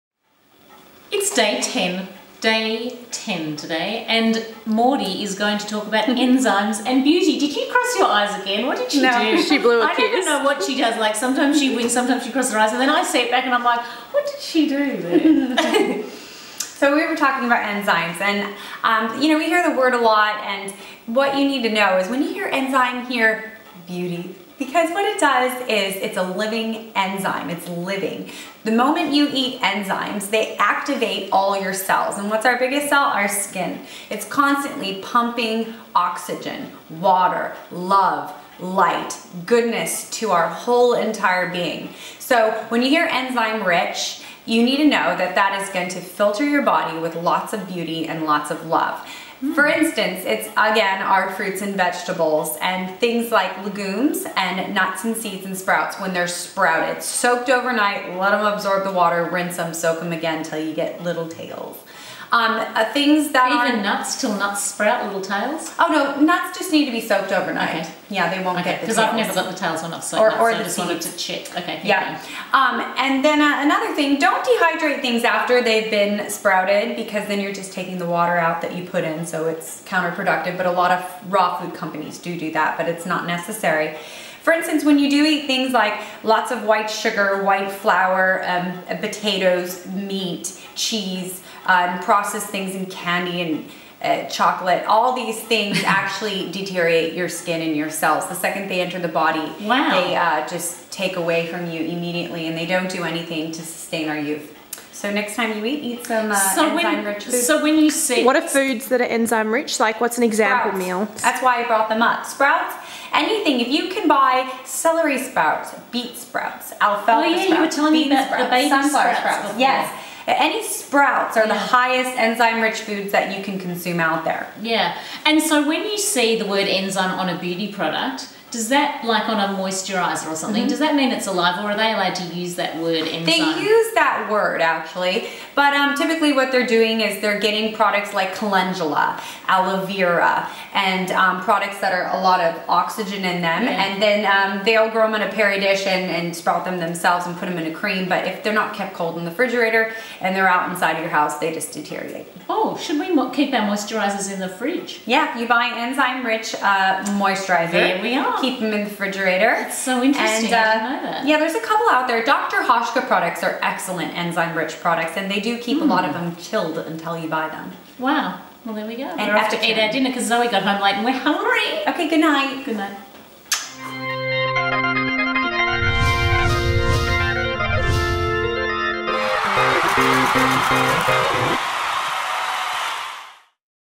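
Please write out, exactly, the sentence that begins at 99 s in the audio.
they uh, just take away from you immediately and they don't do anything to sustain our youth.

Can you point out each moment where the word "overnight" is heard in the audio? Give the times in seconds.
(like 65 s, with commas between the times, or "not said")
57 s, 67 s.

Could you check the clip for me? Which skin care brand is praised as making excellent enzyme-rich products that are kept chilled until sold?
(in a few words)
Dr. Hauschka.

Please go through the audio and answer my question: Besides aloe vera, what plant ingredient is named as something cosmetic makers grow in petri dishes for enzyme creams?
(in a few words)
Calendula.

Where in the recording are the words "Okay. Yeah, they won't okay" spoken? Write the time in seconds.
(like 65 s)
67 s.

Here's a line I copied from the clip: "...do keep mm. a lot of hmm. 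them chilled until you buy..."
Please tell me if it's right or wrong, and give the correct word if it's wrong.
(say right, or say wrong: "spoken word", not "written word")
right.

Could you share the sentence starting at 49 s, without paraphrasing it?
For instance, it's again our fruits and vegetables and things like legumes and nuts and seeds and sprouts when they're sprouted.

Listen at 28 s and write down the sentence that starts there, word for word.
The moment you eat enzymes, they activate all your cells.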